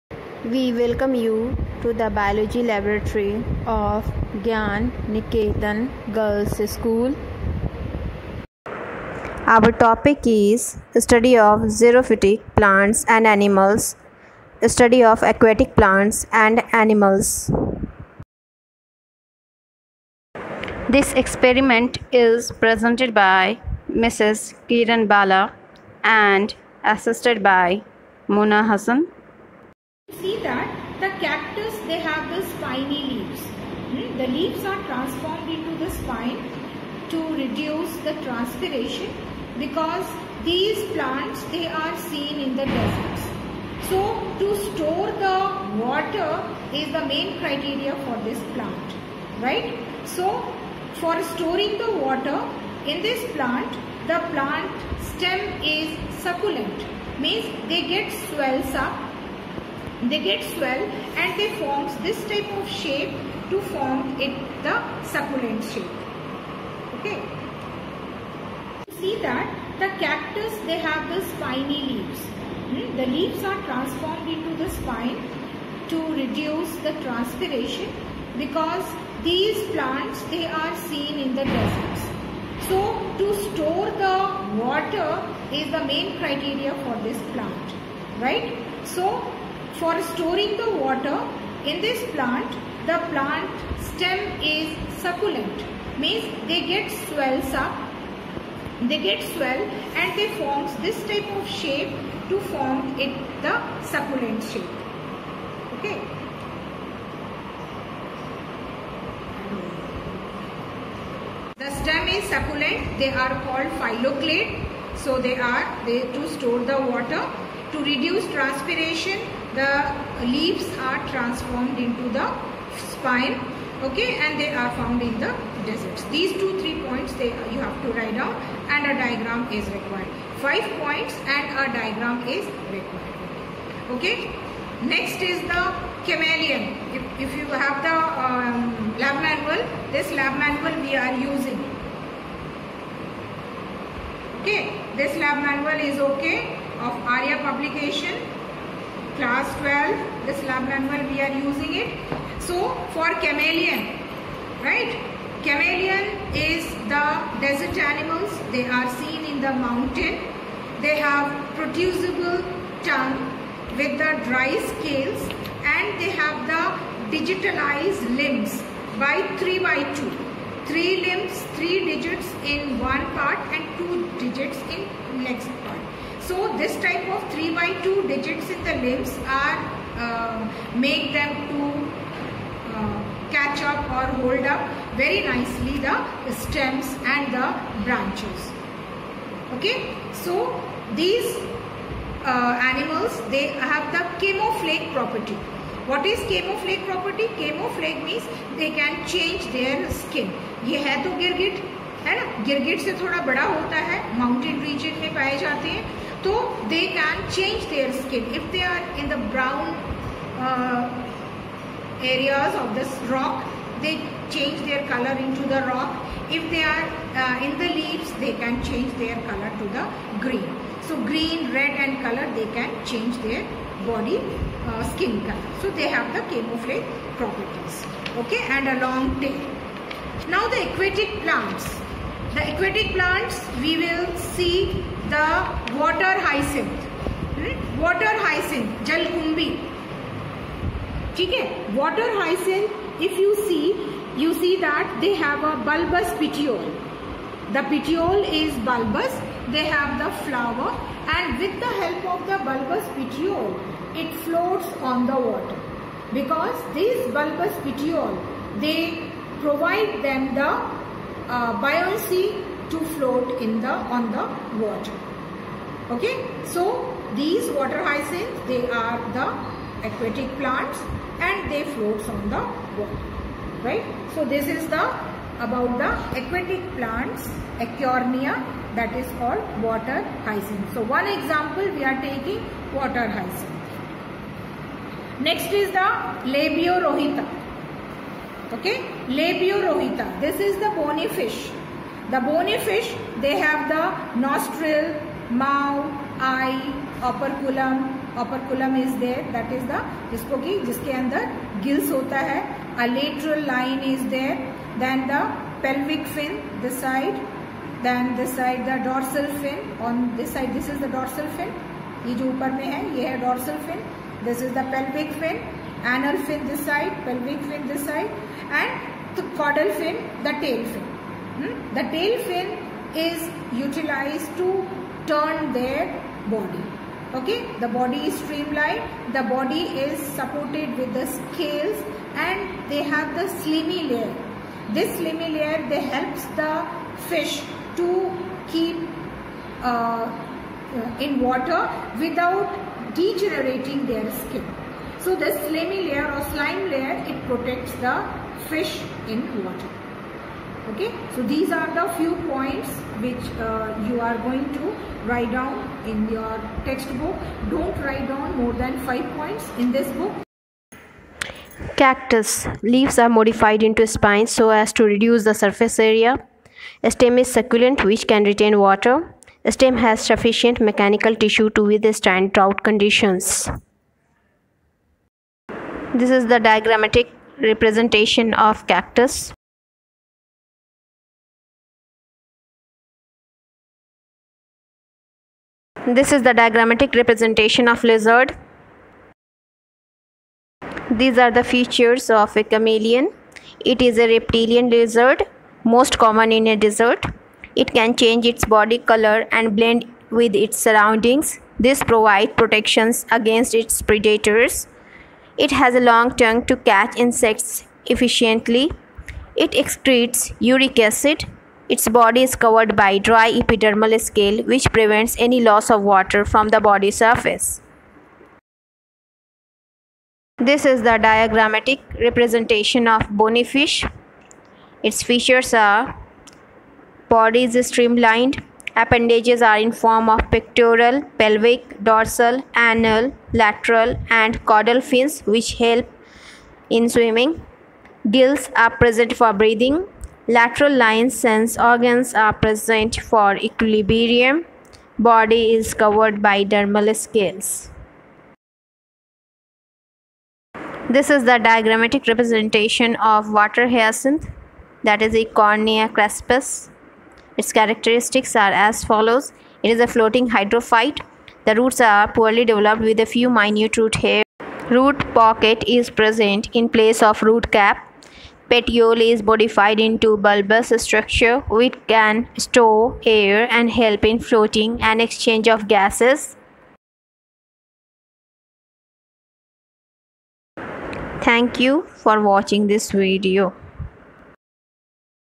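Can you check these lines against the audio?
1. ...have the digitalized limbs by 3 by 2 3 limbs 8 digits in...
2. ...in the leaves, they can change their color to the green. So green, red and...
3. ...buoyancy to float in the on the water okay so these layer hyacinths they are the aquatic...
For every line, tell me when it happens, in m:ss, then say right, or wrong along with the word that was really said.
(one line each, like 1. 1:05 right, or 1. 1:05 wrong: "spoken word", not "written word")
1. 2:46 wrong: "3", not "8"
2. 3:37 right
3. 4:21 wrong: "water", not "layer".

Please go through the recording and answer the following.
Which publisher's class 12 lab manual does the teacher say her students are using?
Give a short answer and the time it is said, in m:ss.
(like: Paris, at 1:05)
Arya publication, at 2:27.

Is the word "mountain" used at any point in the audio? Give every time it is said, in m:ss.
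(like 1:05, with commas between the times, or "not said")
2:39.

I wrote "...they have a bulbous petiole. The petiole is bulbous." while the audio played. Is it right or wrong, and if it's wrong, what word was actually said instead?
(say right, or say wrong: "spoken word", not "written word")
right.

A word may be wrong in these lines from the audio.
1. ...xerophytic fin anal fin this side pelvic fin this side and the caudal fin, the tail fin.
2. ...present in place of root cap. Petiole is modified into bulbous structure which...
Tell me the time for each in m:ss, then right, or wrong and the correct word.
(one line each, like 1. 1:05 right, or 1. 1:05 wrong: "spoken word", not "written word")
1. 5:14 wrong: "pelvic", not "xerophytic"
2. 7:45 right.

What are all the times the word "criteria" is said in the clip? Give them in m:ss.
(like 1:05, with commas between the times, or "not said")
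0:47, 1:26.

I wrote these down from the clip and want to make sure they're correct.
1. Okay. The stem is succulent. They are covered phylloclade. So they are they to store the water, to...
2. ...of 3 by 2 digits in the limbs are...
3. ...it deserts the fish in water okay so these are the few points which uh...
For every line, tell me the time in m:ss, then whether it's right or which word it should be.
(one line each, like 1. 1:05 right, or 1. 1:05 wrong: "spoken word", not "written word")
1. 1:45 wrong: "called", not "covered"
2. 2:57 right
3. 5:47 wrong: "protects", not "deserts".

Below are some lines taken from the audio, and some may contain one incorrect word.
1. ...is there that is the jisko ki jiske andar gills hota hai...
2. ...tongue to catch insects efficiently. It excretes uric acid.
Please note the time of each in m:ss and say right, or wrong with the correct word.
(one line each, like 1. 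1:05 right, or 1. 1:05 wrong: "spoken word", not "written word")
1. 4:58 right
2. 6:46 right.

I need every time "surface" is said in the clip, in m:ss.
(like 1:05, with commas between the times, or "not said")
6:05, 6:56.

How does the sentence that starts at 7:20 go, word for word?
Lateral lines sense organs are present for equilibrium.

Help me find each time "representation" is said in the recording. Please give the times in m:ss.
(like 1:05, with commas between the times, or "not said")
6:17, 6:26, 7:01, 7:32.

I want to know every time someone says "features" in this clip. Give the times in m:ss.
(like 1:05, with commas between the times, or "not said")
6:31, 7:05.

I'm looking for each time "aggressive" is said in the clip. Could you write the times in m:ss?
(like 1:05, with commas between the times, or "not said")
not said.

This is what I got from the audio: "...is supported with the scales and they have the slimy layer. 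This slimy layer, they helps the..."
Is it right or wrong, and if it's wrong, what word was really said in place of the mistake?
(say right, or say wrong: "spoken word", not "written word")
right.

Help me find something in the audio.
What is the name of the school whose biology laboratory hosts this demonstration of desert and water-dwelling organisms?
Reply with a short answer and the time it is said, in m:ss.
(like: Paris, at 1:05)
Gyan Niketan Girls School, at 0:04.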